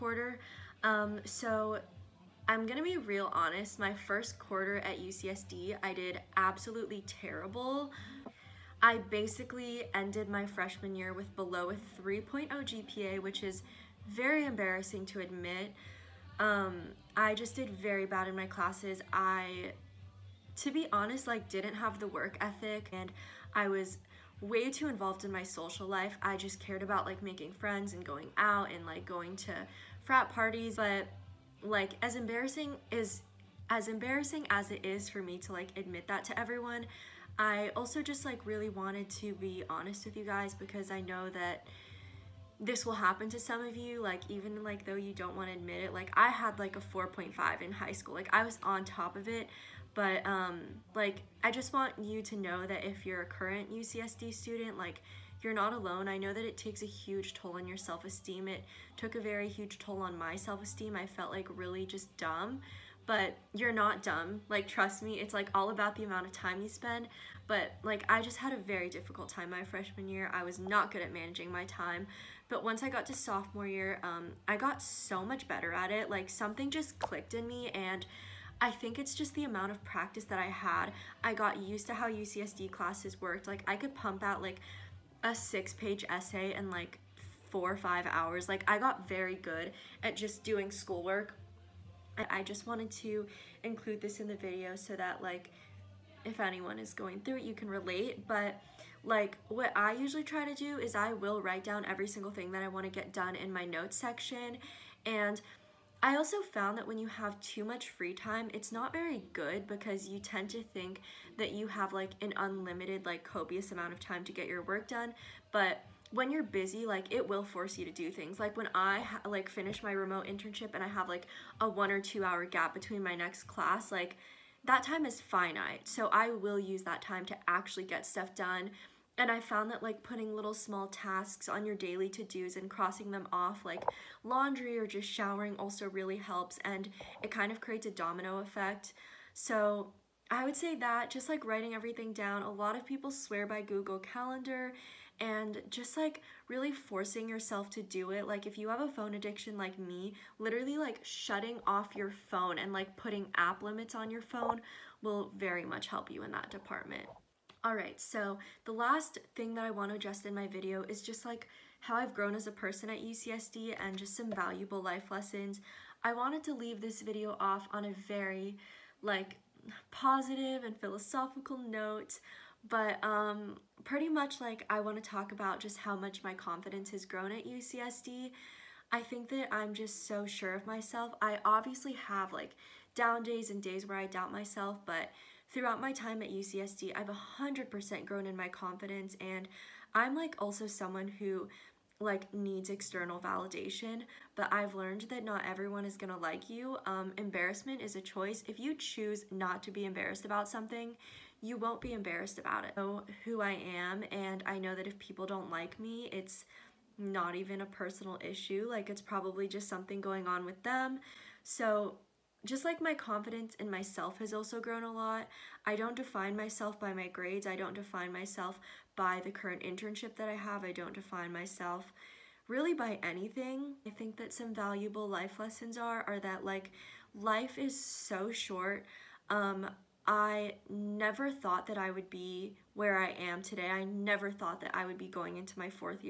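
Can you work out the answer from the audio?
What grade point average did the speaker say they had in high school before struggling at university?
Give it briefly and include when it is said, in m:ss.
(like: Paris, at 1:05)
4.5, at 0:46.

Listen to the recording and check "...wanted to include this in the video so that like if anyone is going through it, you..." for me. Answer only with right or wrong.
right.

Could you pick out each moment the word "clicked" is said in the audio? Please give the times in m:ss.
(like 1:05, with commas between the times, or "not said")
1:16.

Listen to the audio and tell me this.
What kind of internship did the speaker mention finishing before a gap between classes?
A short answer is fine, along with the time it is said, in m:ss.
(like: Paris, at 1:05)
remote internship, at 1:59.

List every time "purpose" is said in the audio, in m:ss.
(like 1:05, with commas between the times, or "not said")
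not said.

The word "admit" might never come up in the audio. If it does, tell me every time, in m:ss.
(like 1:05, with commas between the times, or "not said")
0:15, 0:35, 0:45.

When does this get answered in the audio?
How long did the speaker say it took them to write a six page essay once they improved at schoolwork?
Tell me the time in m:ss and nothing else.
1:27.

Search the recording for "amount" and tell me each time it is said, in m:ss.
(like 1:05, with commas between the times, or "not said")
1:06, 1:19, 1:53.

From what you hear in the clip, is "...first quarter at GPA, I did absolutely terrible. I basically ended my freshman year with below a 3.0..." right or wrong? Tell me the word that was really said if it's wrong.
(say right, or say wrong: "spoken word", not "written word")
wrong: "UCSD", not "GPA".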